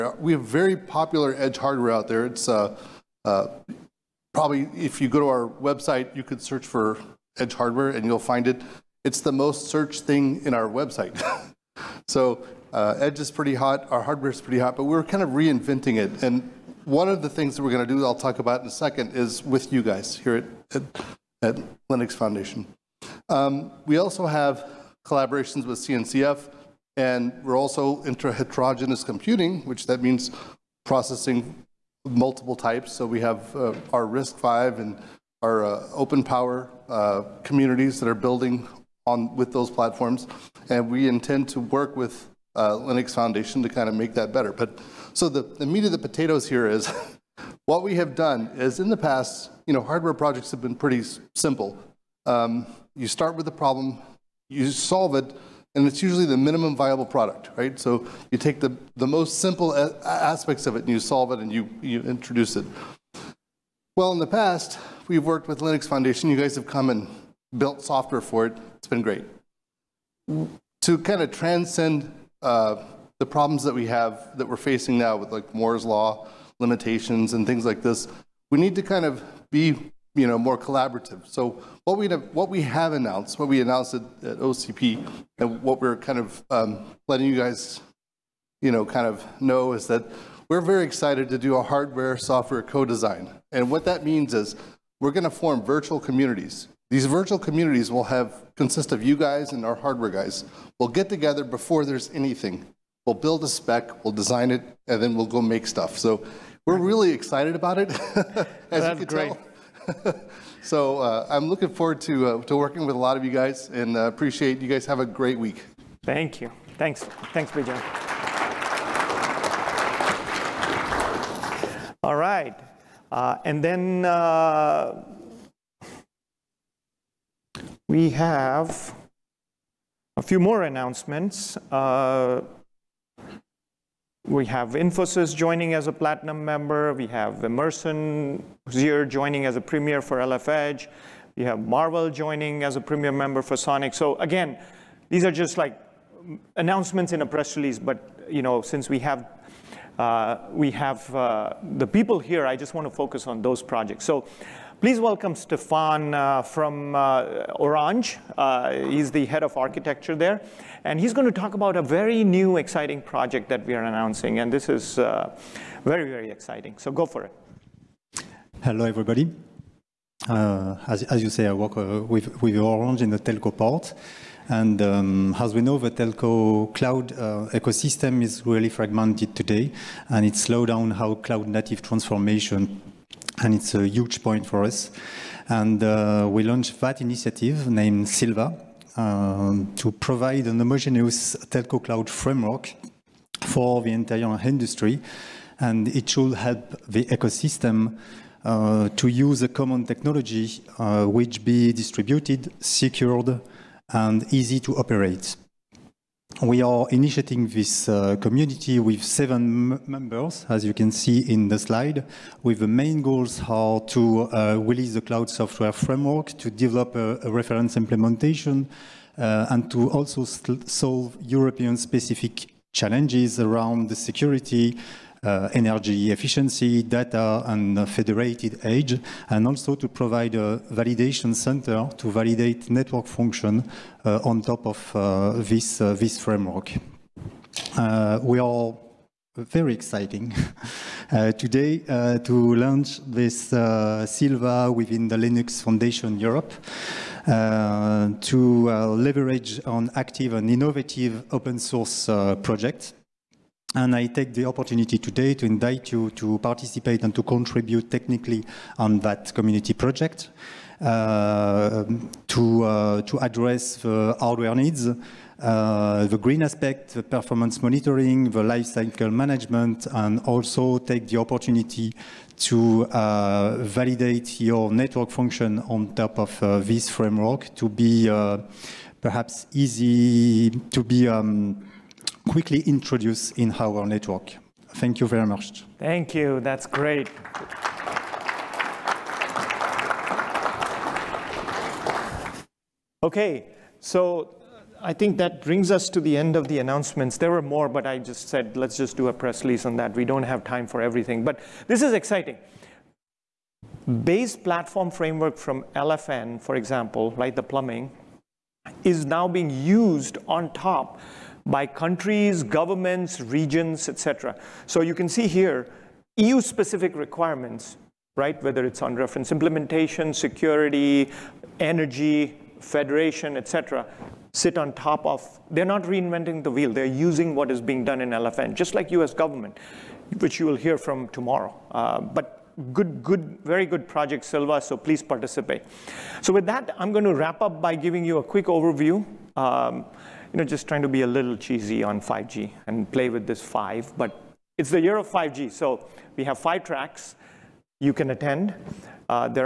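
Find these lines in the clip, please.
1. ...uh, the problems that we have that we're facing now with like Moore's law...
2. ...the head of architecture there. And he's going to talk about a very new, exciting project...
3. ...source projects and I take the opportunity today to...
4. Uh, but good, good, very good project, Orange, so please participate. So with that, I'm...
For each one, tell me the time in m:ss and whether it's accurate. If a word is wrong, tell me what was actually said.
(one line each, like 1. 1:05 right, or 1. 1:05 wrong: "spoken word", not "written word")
1. 1:12 right
2. 2:39 right
3. 4:11 right
4. 5:31 wrong: "Sylva", not "Orange".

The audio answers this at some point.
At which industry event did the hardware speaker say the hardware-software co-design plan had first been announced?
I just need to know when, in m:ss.
1:24.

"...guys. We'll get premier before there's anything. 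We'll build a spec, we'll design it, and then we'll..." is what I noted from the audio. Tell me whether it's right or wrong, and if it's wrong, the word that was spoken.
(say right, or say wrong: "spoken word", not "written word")
wrong: "together", not "premier".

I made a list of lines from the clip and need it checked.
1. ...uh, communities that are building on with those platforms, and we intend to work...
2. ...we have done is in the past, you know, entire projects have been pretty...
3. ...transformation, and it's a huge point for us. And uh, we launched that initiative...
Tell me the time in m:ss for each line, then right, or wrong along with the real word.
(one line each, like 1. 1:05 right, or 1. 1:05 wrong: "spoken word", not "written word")
1. 0:36 right
2. 0:47 wrong: "hardware", not "entire"
3. 3:01 right.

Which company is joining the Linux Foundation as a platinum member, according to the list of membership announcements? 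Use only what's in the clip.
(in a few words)
Infosys.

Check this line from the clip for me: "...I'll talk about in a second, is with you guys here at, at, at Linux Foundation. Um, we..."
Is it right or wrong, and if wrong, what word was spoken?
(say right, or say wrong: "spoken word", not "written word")
right.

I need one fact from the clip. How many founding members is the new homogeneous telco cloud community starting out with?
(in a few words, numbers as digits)
7.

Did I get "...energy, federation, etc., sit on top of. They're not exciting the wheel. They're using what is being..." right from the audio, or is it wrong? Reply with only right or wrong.
wrong.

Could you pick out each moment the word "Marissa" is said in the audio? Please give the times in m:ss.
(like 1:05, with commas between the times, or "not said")
not said.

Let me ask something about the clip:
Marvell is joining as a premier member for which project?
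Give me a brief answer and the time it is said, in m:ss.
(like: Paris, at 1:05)
Sonic, at 2:23.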